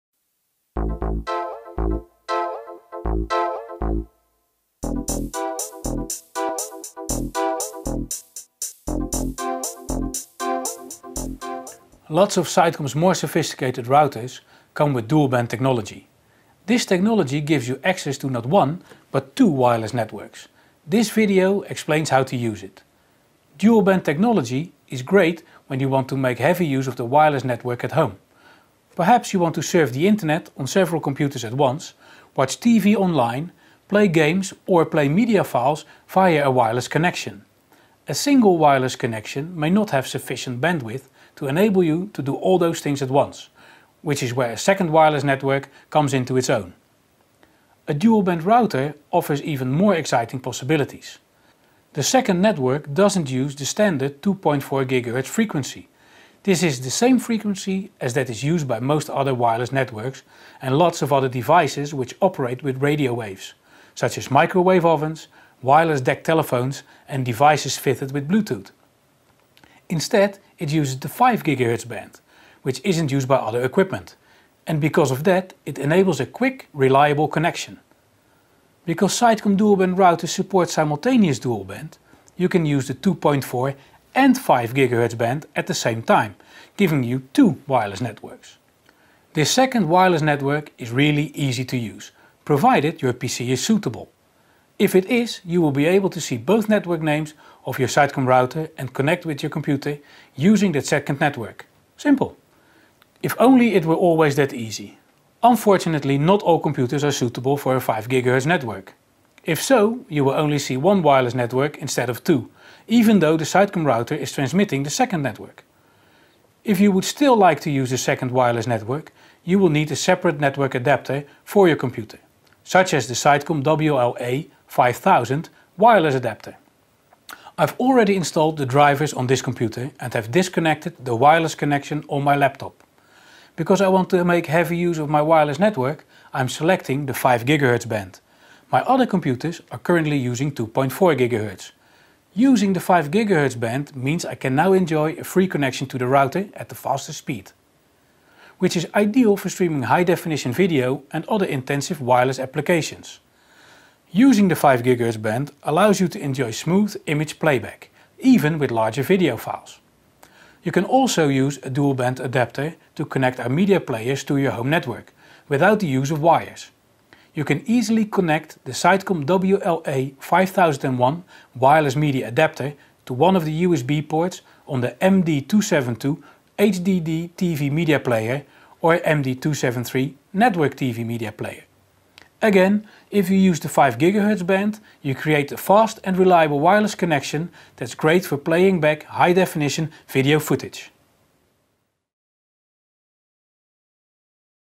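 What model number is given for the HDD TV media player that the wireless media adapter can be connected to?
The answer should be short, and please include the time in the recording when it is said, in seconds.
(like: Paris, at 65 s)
MD272, at 175 s.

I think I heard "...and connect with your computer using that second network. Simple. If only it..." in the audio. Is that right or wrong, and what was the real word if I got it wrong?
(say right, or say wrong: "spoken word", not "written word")
right.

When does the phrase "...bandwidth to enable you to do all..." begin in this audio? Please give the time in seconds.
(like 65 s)
40 s.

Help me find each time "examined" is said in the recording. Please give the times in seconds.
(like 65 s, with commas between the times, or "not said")
not said.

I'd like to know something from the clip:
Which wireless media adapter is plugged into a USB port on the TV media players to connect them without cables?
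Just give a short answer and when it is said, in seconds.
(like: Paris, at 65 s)
Sitecom WLA5001, at 168 s.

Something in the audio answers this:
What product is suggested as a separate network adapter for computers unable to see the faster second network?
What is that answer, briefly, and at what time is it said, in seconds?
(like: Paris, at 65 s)
Sitecom WLA 5000, at 123 s.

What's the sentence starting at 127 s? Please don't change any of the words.
I've already installed the drivers on this computer and have disconnected the wireless connection on my laptop.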